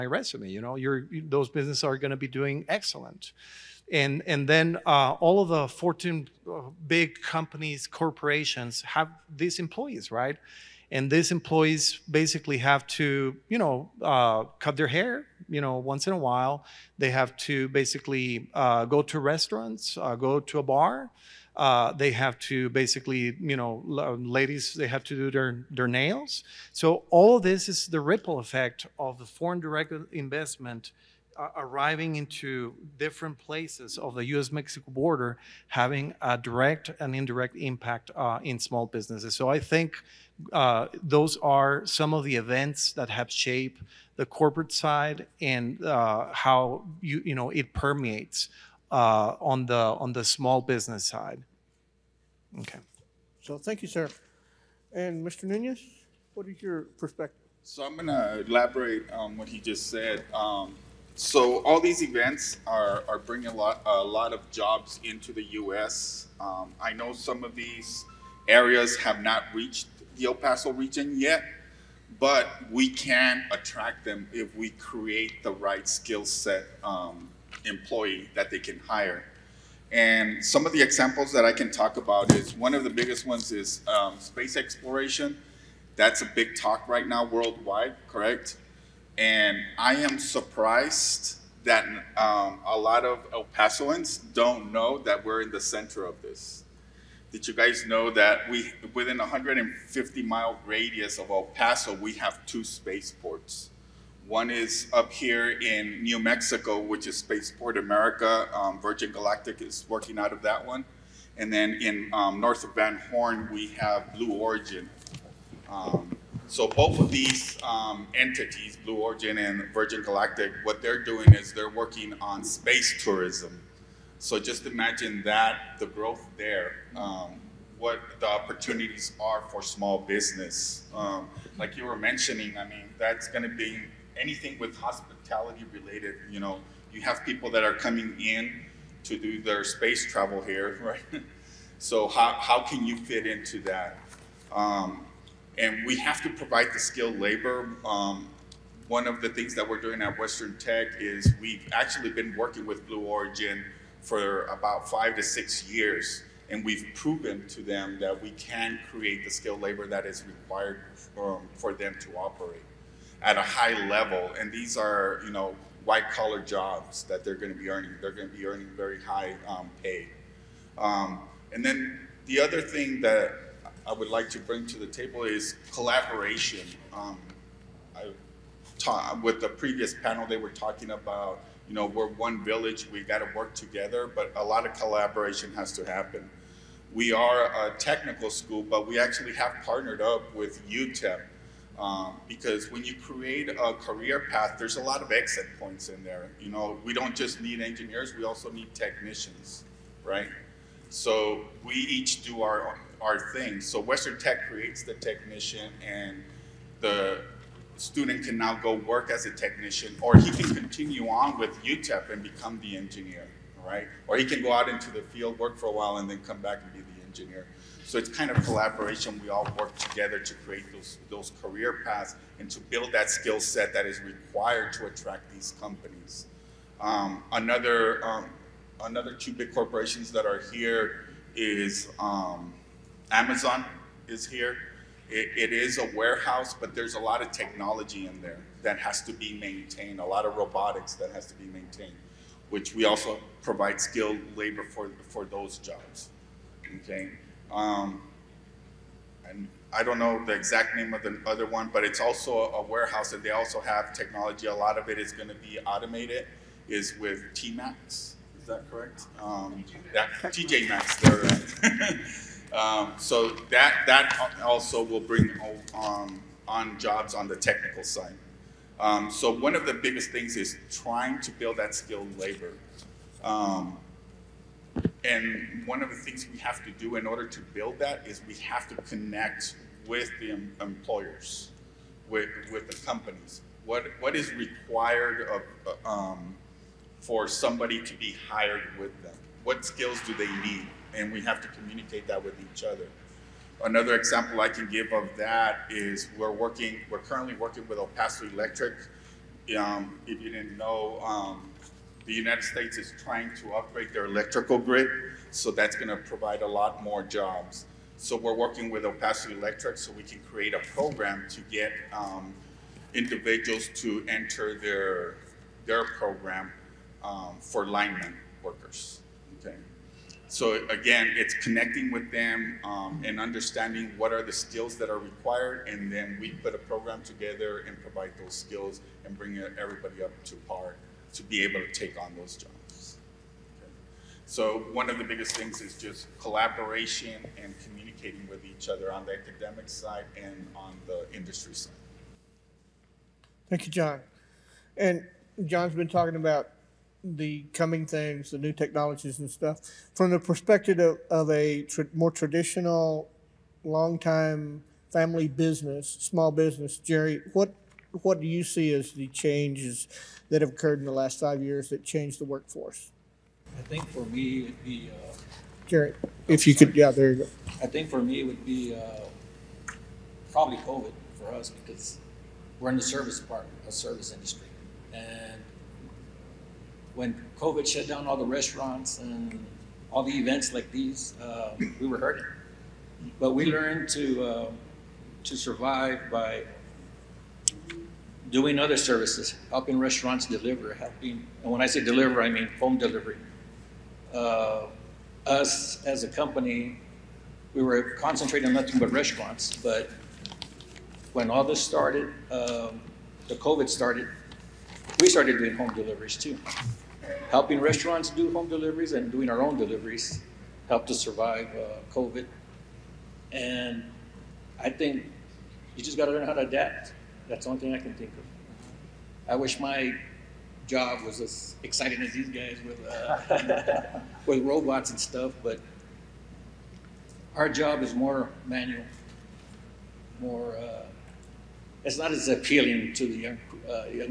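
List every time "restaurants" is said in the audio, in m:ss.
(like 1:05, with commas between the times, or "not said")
0:19, 6:18, 6:29, 6:38, 6:47.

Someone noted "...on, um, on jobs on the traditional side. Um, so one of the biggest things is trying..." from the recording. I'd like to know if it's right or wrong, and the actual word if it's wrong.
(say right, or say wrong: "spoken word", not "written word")
wrong: "technical", not "traditional".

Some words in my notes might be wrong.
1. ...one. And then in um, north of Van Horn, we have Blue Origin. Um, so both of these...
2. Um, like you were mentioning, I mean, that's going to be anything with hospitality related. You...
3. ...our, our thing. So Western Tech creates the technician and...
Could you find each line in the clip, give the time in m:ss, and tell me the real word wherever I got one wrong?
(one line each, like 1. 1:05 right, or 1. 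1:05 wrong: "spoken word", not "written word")
1. 1:50 right
2. 2:10 right
3. 3:22 right.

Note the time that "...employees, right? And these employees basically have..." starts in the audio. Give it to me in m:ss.
0:09.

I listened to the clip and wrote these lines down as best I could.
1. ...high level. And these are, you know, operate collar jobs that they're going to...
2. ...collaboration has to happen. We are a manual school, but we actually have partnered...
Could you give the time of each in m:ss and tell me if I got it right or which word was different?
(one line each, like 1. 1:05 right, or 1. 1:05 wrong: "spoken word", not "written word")
1. 2:43 wrong: "white", not "operate"
2. 3:04 wrong: "technical", not "manual".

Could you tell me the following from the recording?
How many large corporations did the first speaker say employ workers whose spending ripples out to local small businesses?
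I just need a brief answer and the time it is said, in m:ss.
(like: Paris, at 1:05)
14, at 0:05.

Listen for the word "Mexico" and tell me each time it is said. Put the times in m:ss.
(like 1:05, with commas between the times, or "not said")
0:34, 1:46.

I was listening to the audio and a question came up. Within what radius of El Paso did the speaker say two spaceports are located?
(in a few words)
150 miles.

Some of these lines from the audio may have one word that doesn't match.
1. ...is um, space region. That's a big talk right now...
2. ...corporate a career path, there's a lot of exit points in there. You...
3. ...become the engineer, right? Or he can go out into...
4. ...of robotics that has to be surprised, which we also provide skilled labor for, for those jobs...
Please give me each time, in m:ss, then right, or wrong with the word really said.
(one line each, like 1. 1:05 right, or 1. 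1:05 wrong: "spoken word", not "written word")
1. 1:23 wrong: "exploration", not "region"
2. 3:12 wrong: "create", not "corporate"
3. 3:32 right
4. 4:00 wrong: "maintained", not "surprised".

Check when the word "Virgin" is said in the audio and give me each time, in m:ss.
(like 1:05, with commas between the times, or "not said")
1:48, 1:59.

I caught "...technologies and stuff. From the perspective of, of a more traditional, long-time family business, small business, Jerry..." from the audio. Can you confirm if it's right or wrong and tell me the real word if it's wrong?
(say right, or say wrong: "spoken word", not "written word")
right.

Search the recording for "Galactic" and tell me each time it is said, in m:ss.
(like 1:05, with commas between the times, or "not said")
1:49, 2:00.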